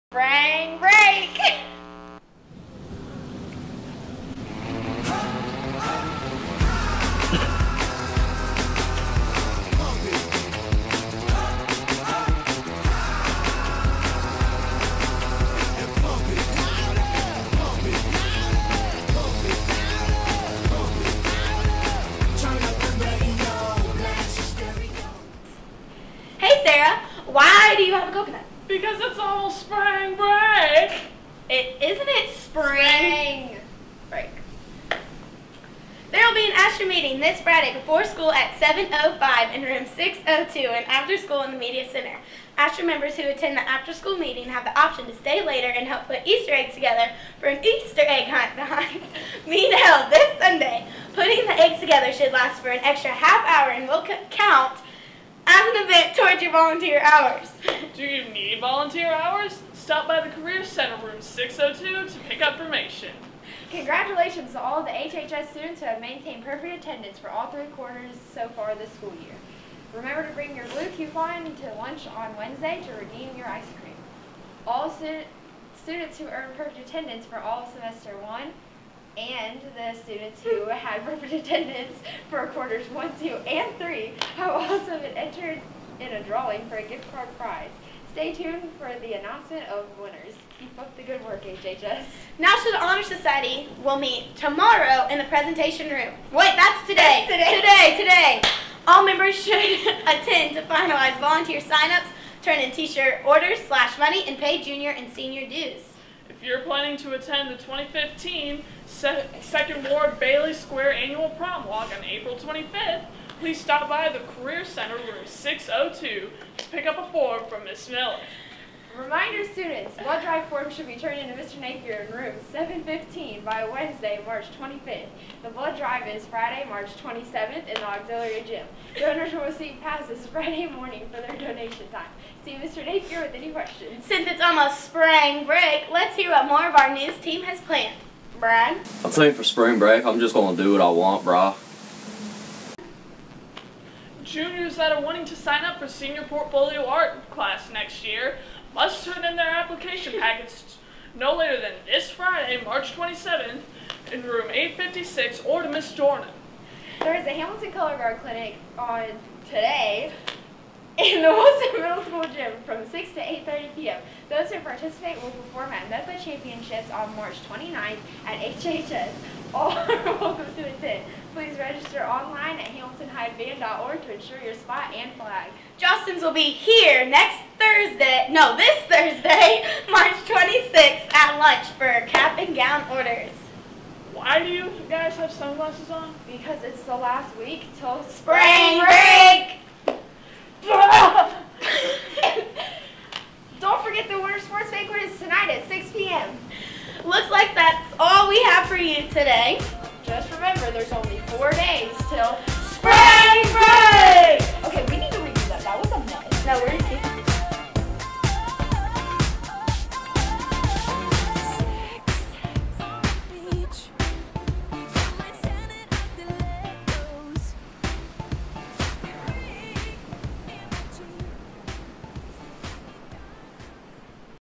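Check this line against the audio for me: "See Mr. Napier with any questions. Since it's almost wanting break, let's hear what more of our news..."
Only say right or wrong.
wrong.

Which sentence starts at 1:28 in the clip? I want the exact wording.
Stay tuned for the announcement of winners.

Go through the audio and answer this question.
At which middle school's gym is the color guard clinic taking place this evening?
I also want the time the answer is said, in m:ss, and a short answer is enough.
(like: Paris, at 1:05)
Wilson Middle School, at 2:41.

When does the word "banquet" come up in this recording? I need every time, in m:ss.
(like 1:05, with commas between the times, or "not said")
3:14.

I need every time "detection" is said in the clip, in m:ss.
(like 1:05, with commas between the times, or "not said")
not said.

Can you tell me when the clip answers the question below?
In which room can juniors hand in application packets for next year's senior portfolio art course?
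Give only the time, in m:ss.
2:34.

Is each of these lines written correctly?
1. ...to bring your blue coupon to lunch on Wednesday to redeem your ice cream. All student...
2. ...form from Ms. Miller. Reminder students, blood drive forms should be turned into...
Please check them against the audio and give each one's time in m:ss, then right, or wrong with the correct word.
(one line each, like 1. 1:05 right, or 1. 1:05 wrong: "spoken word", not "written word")
1. 1:10 right
2. 1:57 right.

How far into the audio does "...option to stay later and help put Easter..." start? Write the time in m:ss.
0:44.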